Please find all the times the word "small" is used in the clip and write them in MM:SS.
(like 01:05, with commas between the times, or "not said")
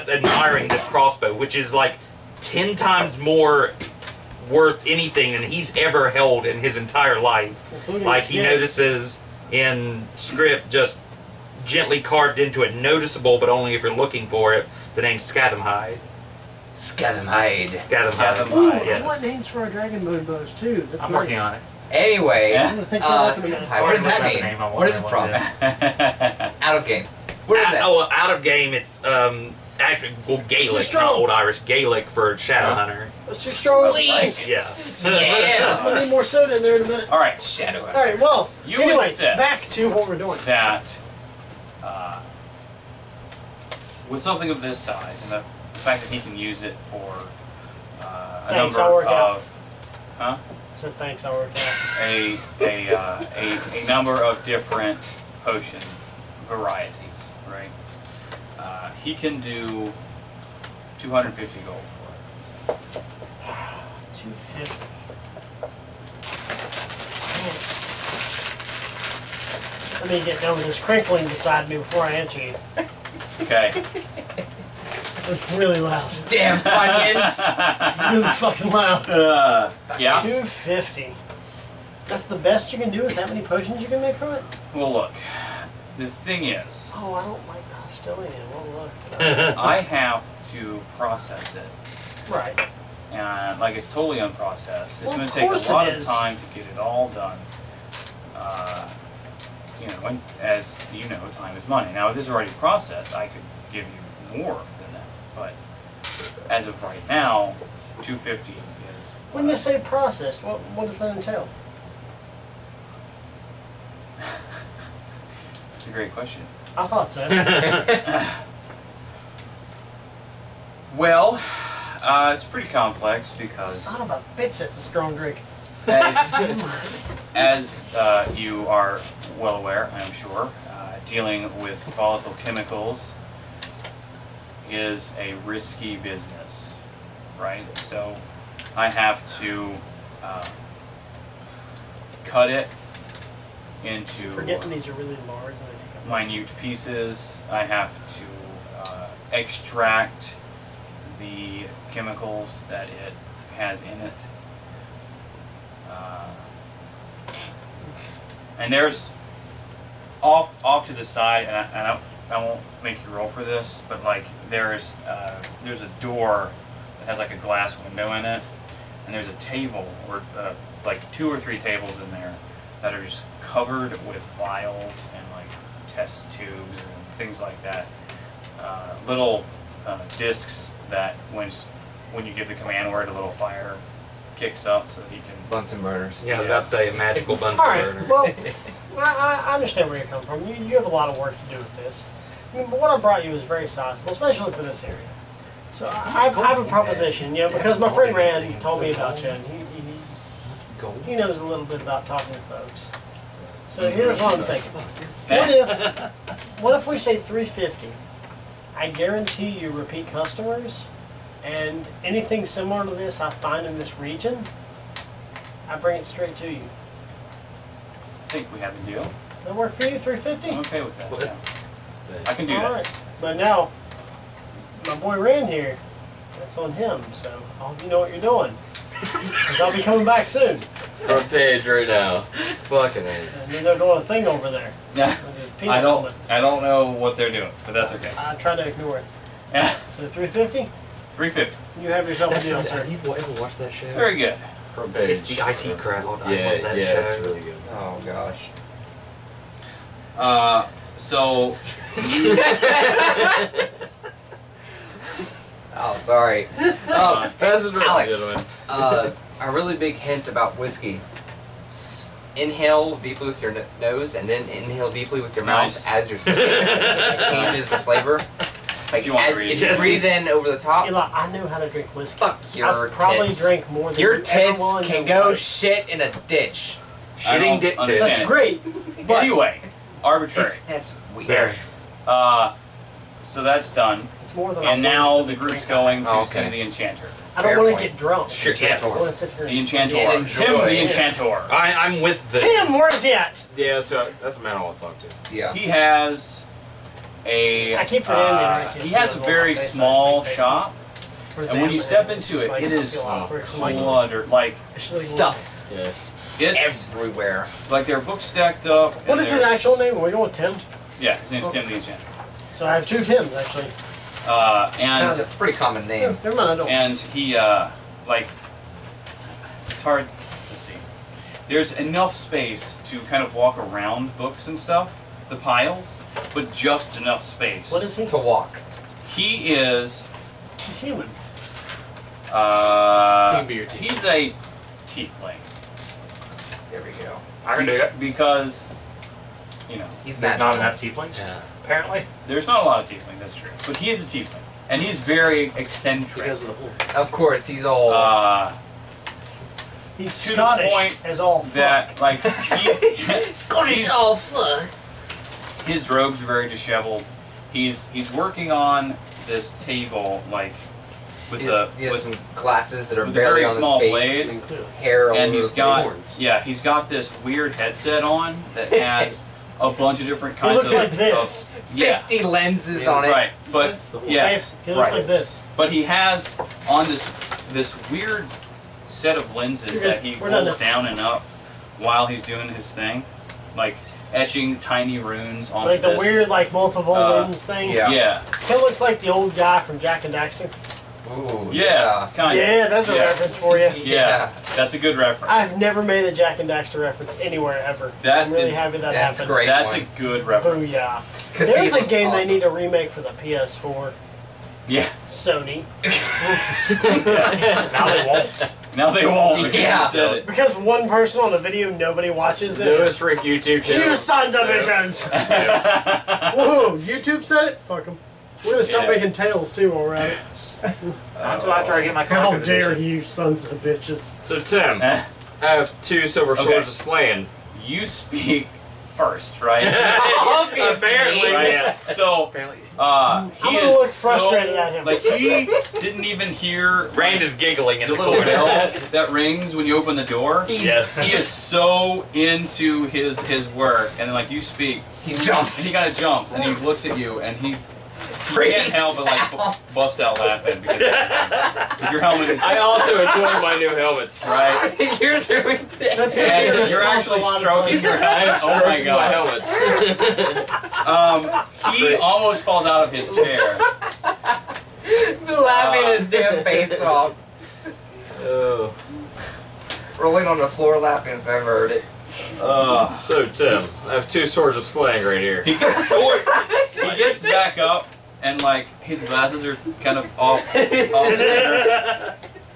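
04:59, 06:03.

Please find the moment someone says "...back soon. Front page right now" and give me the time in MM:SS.
03:50.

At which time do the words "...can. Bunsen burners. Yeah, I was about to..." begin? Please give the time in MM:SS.
03:05.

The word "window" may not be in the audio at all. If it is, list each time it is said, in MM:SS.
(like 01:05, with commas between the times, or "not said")
02:47.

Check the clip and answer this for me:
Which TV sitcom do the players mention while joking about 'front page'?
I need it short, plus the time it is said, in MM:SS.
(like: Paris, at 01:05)
The IT Crowd, at 04:05.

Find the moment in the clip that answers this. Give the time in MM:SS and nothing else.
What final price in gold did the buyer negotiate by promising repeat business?
03:26.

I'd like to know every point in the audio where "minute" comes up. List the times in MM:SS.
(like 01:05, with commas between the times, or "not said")
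00:36, 02:26.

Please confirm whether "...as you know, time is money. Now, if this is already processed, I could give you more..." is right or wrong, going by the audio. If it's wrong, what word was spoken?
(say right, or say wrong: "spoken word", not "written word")
right.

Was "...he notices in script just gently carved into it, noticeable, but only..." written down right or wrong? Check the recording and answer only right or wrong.
right.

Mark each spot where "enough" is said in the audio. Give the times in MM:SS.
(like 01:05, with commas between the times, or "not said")
05:21, 05:26, 05:40.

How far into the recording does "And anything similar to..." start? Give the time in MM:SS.
03:31.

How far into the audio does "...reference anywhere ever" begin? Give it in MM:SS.
06:36.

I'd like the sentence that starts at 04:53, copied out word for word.
Yeah, so that's the man I want to talk to.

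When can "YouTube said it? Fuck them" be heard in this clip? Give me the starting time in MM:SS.
06:56.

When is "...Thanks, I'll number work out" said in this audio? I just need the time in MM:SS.
00:48.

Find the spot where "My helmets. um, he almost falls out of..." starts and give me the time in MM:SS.
07:39.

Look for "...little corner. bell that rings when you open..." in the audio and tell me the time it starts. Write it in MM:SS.
07:17.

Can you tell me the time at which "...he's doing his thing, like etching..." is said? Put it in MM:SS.
06:22.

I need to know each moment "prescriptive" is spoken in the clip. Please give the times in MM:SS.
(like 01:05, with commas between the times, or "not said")
not said.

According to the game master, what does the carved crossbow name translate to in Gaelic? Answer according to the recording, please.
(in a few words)
Shadow Hunter.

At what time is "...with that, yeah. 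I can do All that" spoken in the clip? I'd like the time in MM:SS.
03:40.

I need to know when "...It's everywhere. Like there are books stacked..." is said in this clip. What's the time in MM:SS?
05:06.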